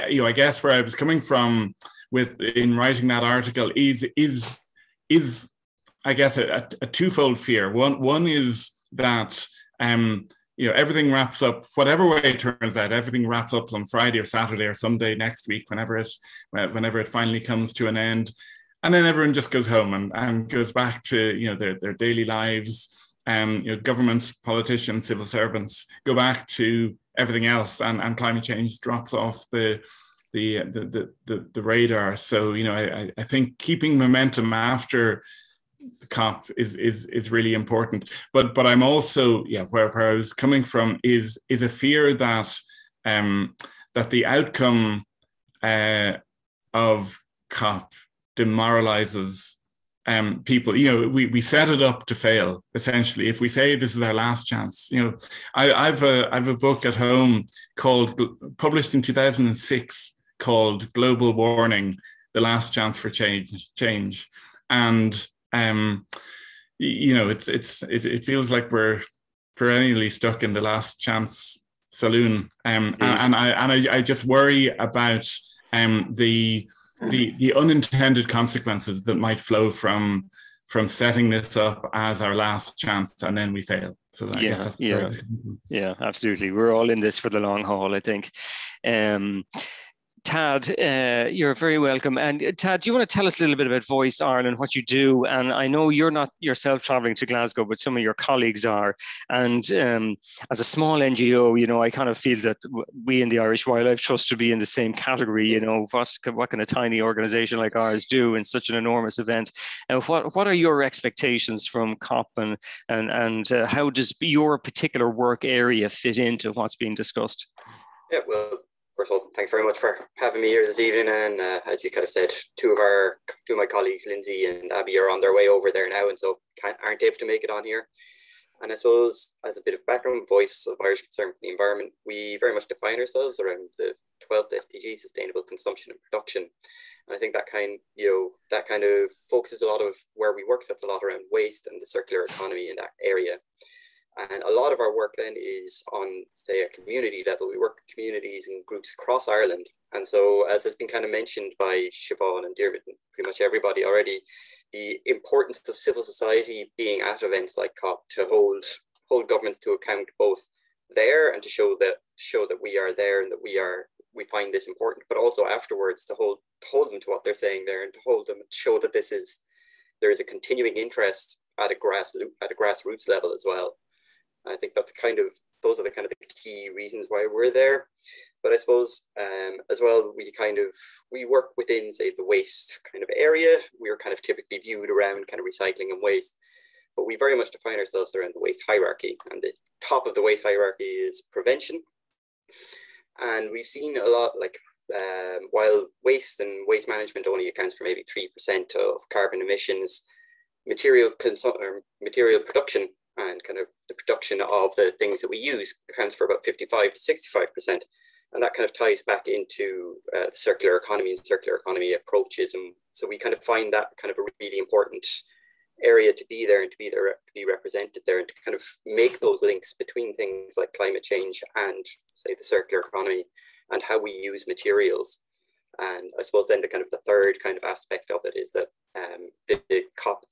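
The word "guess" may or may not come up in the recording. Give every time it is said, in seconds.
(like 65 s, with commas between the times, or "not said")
0 s, 6 s.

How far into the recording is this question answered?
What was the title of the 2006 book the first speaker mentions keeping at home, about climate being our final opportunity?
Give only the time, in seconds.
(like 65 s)
60 s.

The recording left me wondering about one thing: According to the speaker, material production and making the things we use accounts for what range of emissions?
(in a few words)
55 to 65 percent.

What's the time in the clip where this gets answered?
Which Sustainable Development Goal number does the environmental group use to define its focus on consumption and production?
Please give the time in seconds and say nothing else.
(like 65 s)
134 s.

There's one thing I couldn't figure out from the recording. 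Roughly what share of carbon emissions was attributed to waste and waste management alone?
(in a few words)
3%.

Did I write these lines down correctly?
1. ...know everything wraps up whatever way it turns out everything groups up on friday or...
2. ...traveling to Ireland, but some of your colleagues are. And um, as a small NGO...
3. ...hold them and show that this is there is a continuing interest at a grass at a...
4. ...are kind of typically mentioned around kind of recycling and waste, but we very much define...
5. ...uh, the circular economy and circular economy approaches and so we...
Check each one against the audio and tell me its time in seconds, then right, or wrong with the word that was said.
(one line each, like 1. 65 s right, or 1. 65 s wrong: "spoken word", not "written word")
1. 10 s wrong: "wraps", not "groups"
2. 96 s wrong: "Glasgow", not "Ireland"
3. 168 s right
4. 183 s wrong: "viewed", not "mentioned"
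5. 210 s right.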